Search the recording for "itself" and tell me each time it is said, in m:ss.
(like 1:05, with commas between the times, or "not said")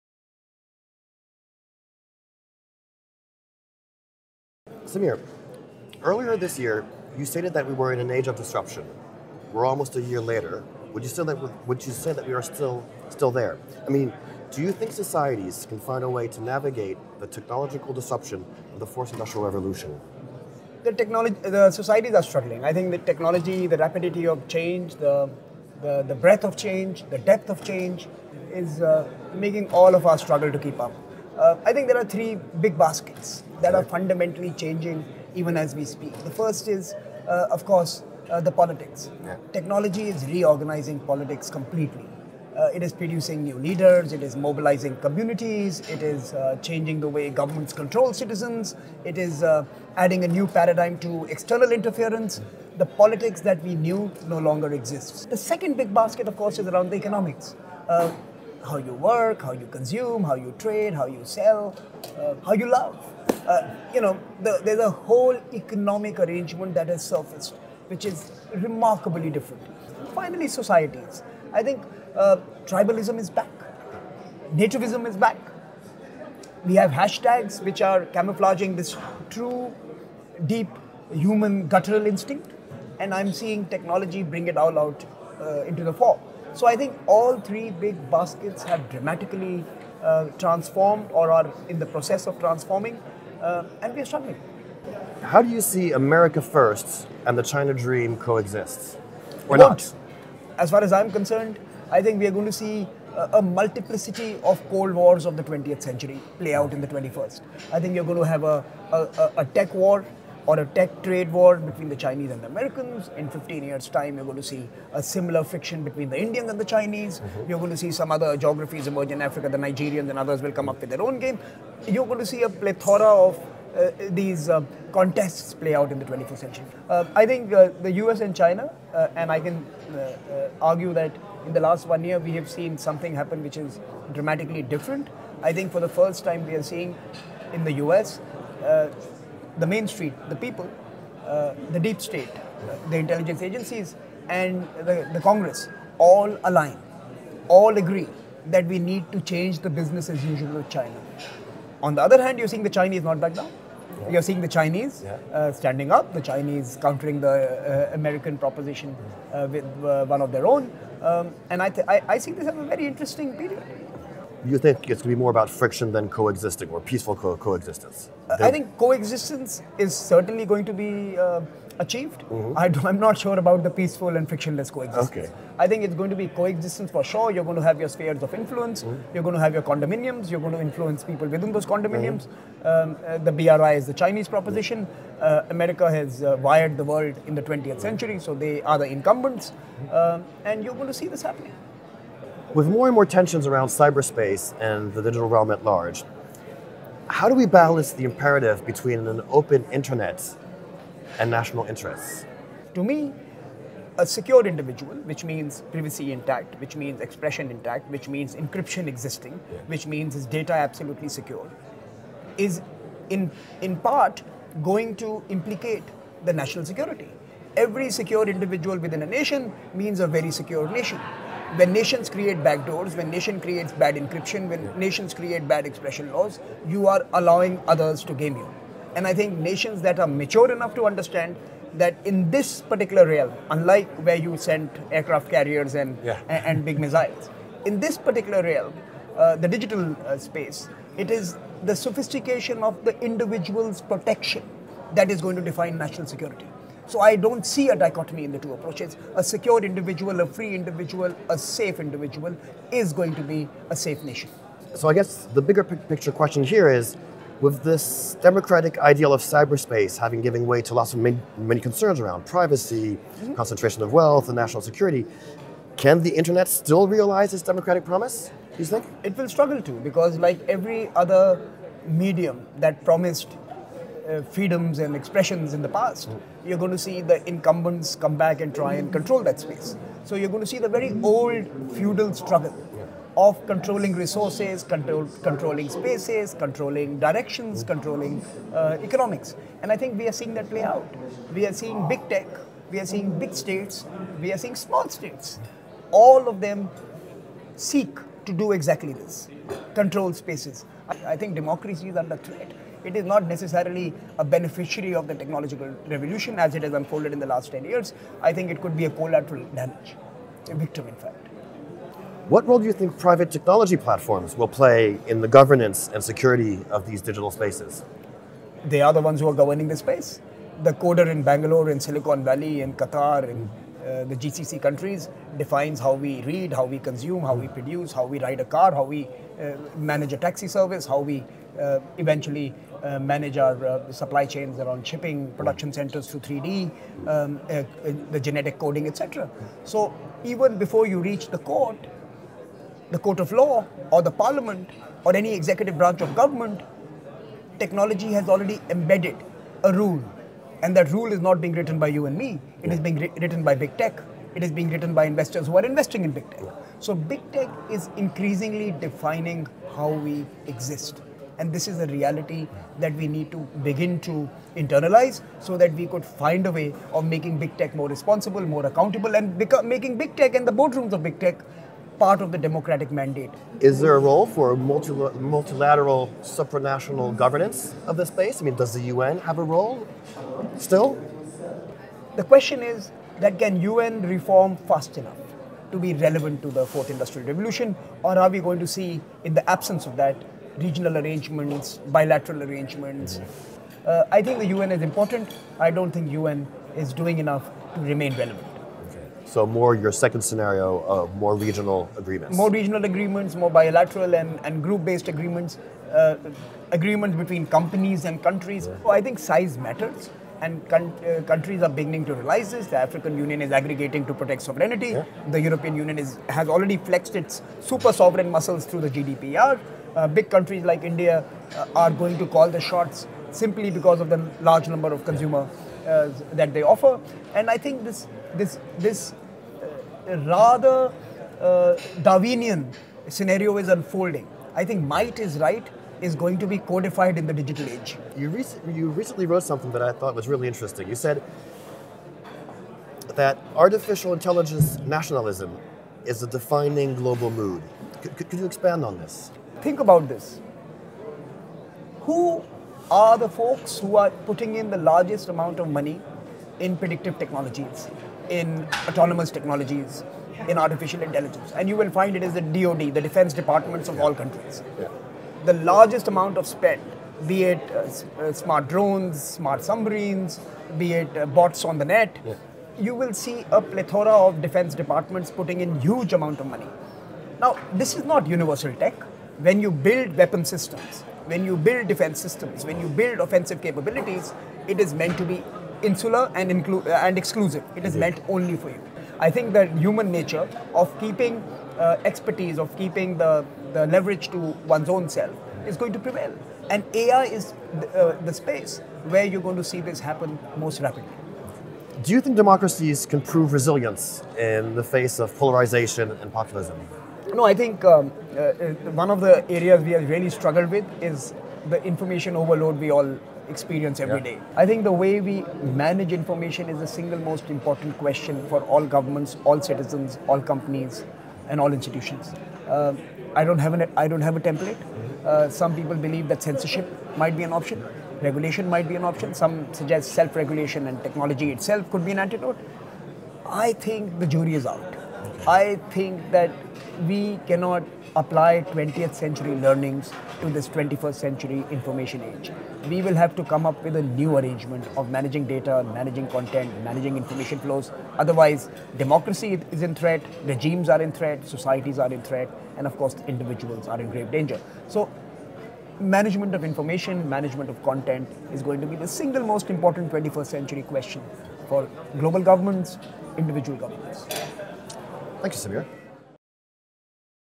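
8:51.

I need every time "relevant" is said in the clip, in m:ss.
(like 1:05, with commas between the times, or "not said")
6:25, 6:38.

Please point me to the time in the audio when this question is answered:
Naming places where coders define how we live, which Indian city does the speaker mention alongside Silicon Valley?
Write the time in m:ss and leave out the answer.
5:21.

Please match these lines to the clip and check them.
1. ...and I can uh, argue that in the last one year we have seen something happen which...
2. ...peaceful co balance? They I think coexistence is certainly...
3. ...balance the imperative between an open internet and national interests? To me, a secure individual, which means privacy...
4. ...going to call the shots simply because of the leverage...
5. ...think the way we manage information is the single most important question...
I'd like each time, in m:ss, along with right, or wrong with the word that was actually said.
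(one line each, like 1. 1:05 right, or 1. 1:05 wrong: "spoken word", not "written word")
1. 2:09 right
2. 2:46 wrong: "coexistence", not "balance"
3. 3:17 right
4. 7:01 wrong: "large", not "leverage"
5. 8:34 right.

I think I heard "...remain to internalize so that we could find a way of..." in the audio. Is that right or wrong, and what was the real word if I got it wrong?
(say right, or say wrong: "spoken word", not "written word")
wrong: "begin", not "remain".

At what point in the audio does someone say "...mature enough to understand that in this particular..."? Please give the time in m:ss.
3:50.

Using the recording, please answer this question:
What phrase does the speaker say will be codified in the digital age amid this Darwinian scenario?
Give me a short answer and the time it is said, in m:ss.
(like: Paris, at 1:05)
Might is right, at 7:14.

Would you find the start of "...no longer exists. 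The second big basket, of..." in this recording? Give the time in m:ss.
0:54.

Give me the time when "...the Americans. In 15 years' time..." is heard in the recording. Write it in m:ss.
1:52.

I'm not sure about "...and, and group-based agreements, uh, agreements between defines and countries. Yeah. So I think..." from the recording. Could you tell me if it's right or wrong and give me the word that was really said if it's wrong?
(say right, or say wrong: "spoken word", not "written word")
wrong: "companies", not "defines".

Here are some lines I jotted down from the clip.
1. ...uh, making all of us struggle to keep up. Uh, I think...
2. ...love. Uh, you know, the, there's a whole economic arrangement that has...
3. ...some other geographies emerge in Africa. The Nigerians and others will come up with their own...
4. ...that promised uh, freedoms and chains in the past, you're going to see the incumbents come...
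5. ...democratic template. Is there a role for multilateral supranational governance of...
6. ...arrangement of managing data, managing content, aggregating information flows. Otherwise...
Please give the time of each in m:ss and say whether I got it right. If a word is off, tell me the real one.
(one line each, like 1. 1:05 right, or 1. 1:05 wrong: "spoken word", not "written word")
1. 0:28 right
2. 1:02 right
3. 1:57 right
4. 4:32 wrong: "expressions", not "chains"
5. 6:12 wrong: "mandate", not "template"
6. 9:04 wrong: "managing", not "aggregating".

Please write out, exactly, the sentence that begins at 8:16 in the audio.
And AI is th- uh, the space where you're going to see this happen most rapidly.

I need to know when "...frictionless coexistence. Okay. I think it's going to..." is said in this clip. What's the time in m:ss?
2:54.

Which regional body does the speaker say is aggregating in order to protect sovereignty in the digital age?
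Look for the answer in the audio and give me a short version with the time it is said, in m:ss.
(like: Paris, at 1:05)
African Union, at 6:52.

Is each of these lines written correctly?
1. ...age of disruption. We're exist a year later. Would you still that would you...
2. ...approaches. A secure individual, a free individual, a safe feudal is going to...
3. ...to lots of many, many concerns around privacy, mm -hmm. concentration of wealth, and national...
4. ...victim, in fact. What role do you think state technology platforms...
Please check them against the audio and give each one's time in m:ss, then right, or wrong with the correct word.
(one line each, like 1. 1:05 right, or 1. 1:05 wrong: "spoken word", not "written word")
1. 0:08 wrong: "almost", not "exist"
2. 4:08 wrong: "individual", not "feudal"
3. 4:20 right
4. 5:10 wrong: "private", not "state".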